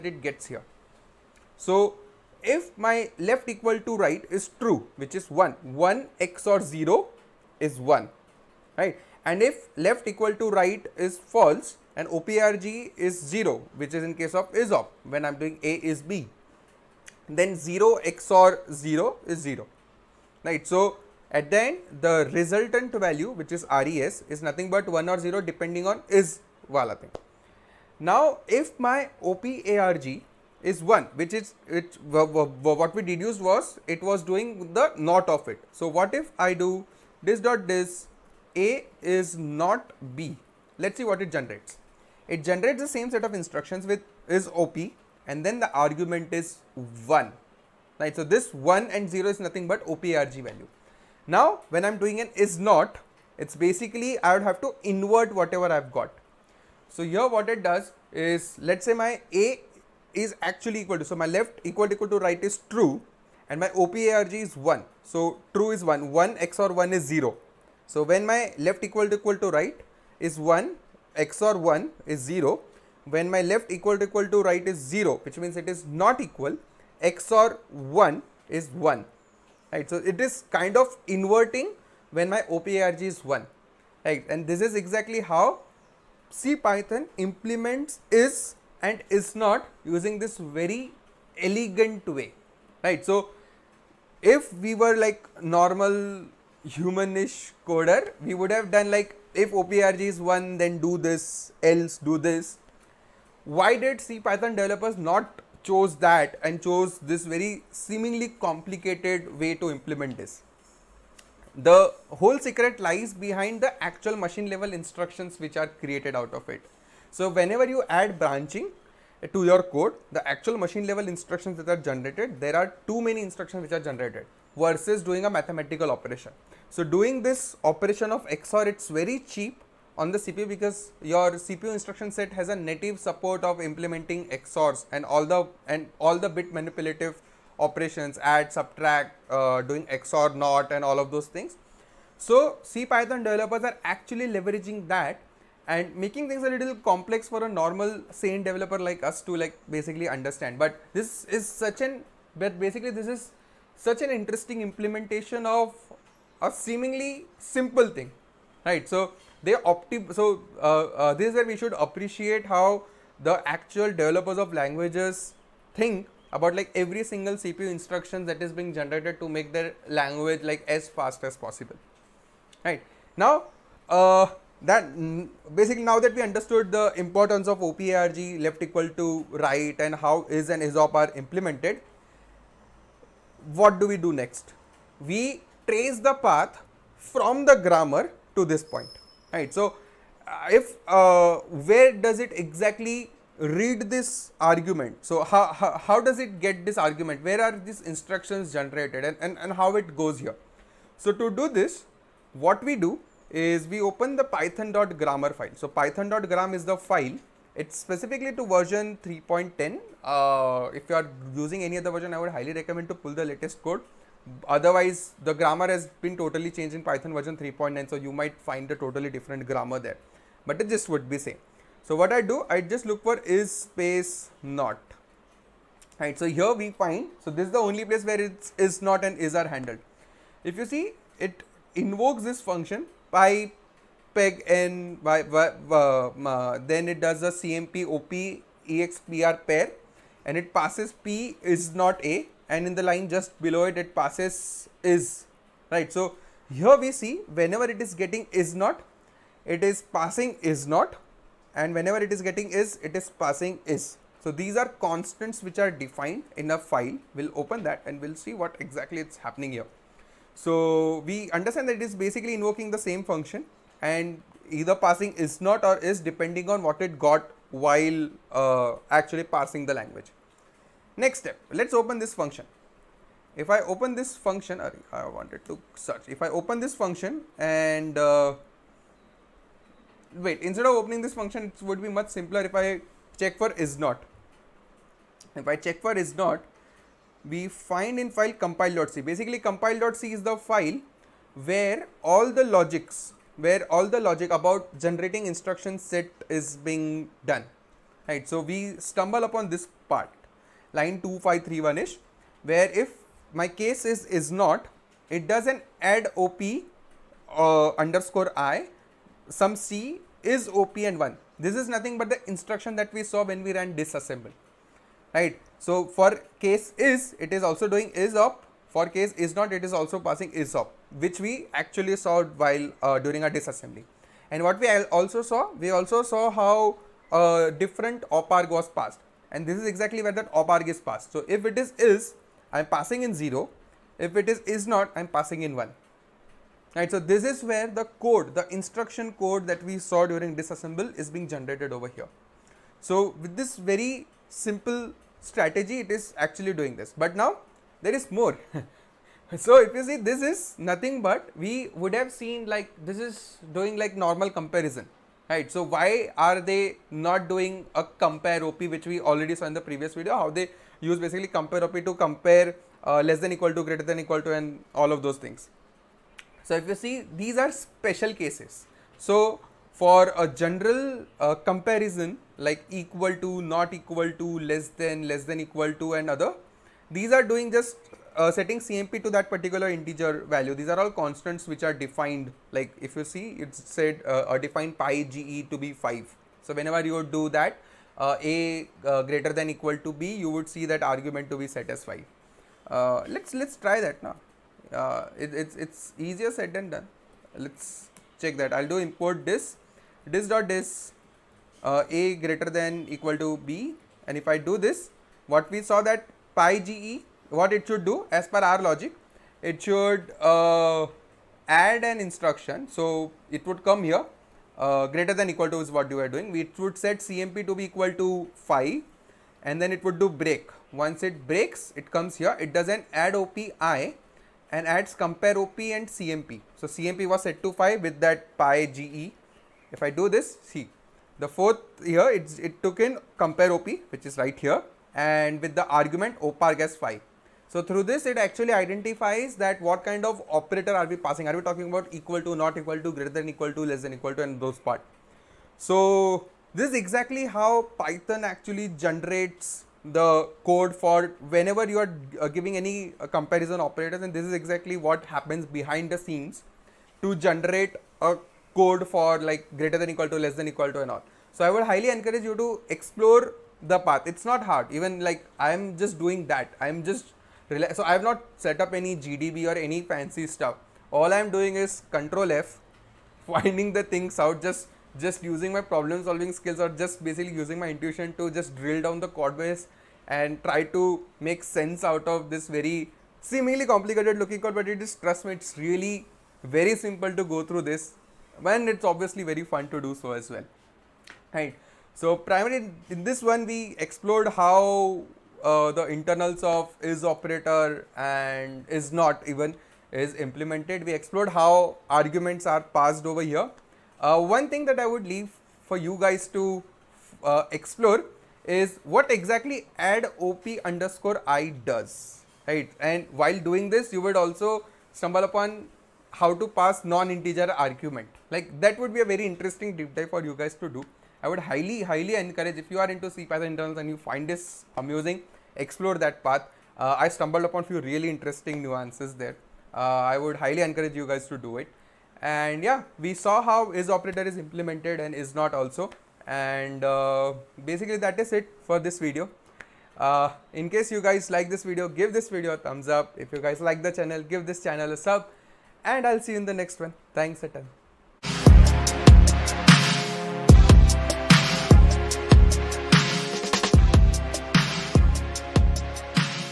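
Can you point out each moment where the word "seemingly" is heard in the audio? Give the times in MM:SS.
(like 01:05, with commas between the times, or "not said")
01:47, 02:36, 08:03.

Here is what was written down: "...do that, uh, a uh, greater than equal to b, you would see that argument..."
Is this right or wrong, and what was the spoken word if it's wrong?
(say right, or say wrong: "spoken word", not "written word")
right.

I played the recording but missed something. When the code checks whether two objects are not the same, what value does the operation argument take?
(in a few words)
1.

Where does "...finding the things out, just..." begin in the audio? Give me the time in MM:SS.
07:53.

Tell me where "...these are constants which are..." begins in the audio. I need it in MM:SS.
04:14.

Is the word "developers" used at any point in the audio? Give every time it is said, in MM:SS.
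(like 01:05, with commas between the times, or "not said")
01:44, 02:23, 02:28, 02:43.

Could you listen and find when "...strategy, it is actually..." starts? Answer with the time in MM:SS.
05:45.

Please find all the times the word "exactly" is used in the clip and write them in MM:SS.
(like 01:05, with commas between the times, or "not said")
01:24, 03:12, 04:18, 05:29, 07:26, 07:34, 08:29.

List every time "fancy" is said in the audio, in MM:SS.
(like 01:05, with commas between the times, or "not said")
07:49.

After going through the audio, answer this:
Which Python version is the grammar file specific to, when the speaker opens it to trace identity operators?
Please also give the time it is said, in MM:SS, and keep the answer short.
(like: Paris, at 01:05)
3.10, at 03:29.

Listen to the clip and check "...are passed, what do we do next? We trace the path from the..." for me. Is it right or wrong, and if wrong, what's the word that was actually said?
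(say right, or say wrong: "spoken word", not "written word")
wrong: "implemented", not "passed".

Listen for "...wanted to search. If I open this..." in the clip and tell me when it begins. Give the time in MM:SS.
04:35.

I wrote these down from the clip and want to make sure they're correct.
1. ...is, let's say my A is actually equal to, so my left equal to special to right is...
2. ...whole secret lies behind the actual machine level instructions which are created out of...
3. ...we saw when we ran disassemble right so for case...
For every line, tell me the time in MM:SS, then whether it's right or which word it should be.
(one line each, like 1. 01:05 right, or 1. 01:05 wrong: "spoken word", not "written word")
1. 00:58 wrong: "equal", not "special"
2. 01:52 right
3. 05:12 right.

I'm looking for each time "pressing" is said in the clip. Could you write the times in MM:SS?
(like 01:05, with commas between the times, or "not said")
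not said.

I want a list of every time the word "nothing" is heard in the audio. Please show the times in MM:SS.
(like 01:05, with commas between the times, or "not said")
00:24, 00:49, 05:11, 05:50.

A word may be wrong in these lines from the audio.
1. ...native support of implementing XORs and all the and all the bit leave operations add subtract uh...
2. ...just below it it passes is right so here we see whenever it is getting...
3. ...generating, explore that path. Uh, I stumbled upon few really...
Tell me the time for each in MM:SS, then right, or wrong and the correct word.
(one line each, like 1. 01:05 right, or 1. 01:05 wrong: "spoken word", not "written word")
1. 02:12 wrong: "manipulative", not "leave"
2. 04:03 right
3. 08:44 wrong: "amusing", not "generating".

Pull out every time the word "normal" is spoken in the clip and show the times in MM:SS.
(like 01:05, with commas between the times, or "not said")
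01:35, 02:27, 05:53.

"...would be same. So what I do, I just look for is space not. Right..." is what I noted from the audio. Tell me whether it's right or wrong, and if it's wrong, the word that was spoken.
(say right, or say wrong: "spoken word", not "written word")
right.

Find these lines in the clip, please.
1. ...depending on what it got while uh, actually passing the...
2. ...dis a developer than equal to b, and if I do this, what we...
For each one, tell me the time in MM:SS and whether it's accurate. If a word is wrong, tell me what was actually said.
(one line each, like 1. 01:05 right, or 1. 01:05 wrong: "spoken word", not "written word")
1. 04:25 right
2. 06:40 wrong: "greater", not "developer".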